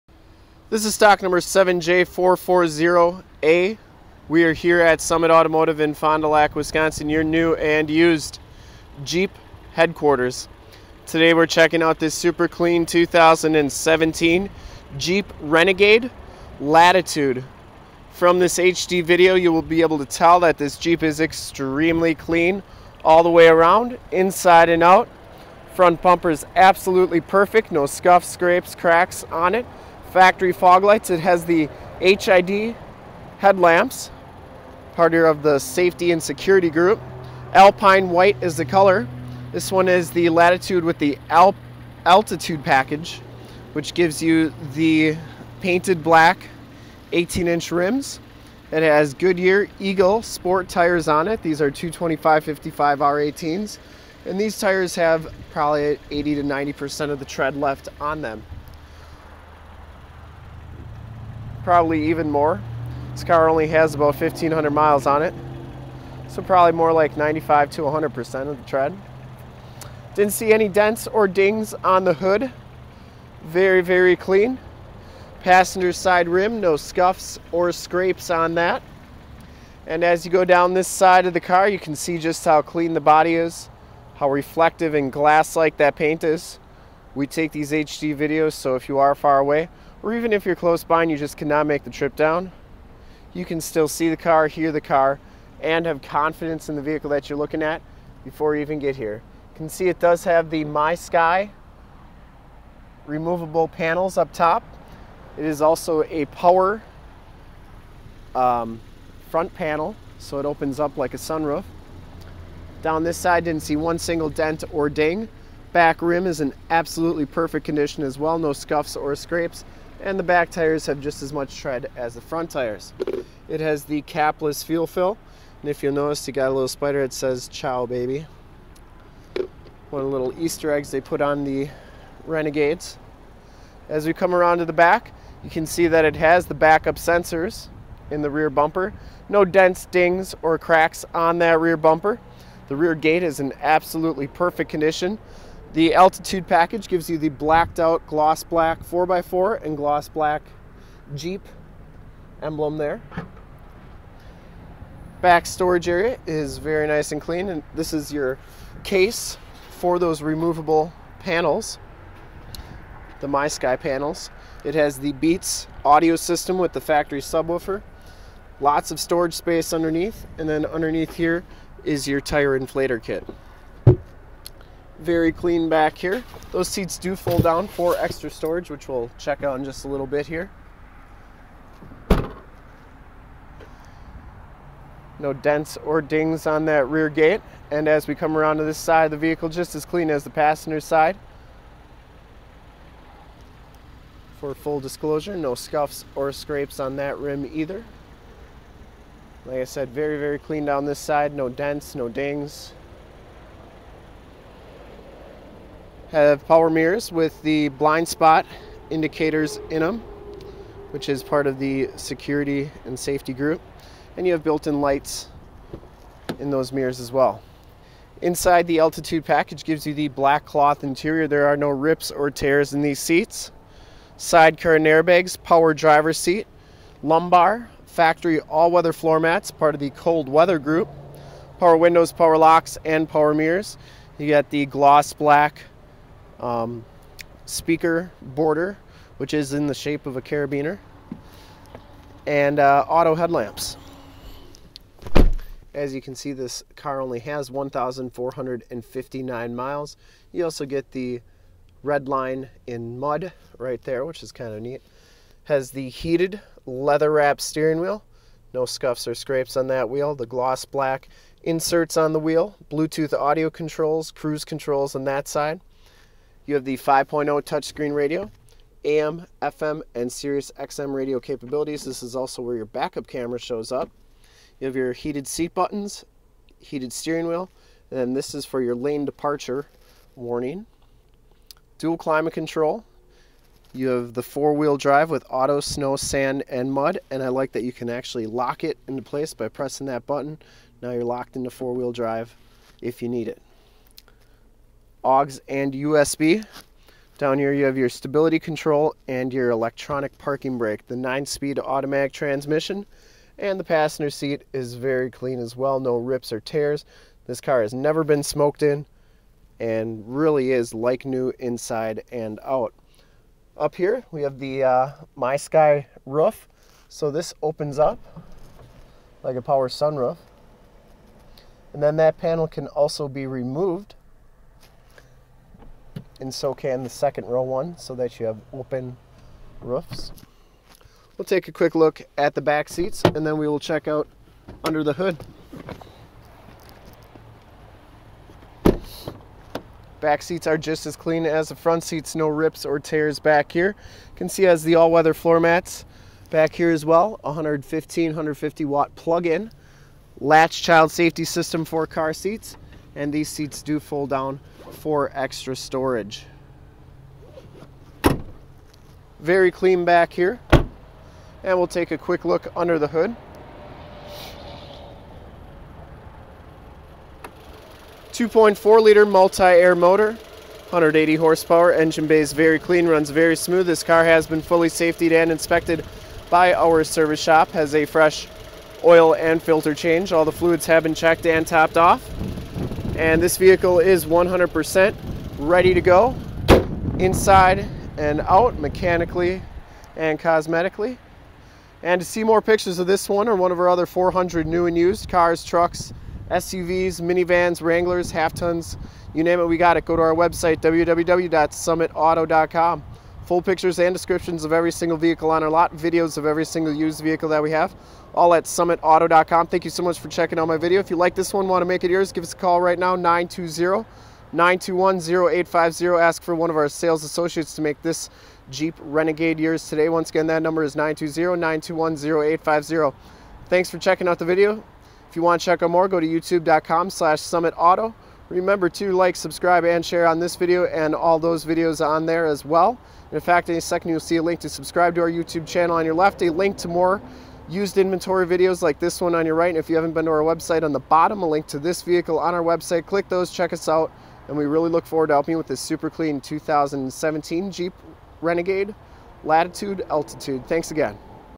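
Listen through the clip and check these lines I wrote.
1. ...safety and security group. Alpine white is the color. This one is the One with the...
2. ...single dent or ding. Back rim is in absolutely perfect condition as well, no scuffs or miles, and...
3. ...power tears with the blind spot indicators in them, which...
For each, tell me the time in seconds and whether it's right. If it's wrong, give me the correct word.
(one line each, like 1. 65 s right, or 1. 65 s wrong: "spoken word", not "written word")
1. 35 s wrong: "Latitude", not "One"
2. 113 s wrong: "scrapes", not "miles"
3. 206 s wrong: "mirrors", not "tears".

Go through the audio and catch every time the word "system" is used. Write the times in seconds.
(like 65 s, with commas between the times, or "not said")
166 s, 351 s.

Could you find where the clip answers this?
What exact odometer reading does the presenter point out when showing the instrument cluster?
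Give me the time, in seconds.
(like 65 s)
247 s.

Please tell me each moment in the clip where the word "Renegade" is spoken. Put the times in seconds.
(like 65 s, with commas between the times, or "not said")
15 s, 132 s, 418 s, 448 s.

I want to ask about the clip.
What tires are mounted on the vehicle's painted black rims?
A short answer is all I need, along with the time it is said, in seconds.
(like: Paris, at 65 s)
Goodyear Eagle sport, at 49 s.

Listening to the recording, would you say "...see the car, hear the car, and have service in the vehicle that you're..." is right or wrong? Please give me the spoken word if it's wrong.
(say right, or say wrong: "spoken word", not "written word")
wrong: "confidence", not "service".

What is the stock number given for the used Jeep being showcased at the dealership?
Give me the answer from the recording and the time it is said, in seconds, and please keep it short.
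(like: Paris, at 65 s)
7J440A, at 1 s.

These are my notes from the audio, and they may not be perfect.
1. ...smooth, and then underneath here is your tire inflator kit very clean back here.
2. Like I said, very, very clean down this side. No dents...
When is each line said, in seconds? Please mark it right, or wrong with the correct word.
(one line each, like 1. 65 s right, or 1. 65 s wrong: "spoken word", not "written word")
1. 169 s wrong: "underneath", not "smooth"
2. 199 s right.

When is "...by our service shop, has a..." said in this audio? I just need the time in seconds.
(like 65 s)
376 s.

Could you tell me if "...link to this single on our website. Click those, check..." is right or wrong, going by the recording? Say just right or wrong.
wrong.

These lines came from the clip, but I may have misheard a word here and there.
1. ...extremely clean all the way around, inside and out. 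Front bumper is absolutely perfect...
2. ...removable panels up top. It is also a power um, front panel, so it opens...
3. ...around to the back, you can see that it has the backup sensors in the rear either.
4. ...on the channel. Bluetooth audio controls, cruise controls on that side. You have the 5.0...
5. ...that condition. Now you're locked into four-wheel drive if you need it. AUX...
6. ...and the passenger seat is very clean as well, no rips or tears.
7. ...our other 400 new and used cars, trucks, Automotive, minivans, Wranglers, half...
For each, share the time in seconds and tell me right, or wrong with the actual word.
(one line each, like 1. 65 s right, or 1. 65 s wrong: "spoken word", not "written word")
1. 21 s right
2. 103 s right
3. 134 s wrong: "bumper", not "either"
4. 261 s wrong: "wheel", not "channel"
5. 289 s wrong: "button", not "condition"
6. 303 s right
7. 393 s wrong: "SUVs", not "Automotive".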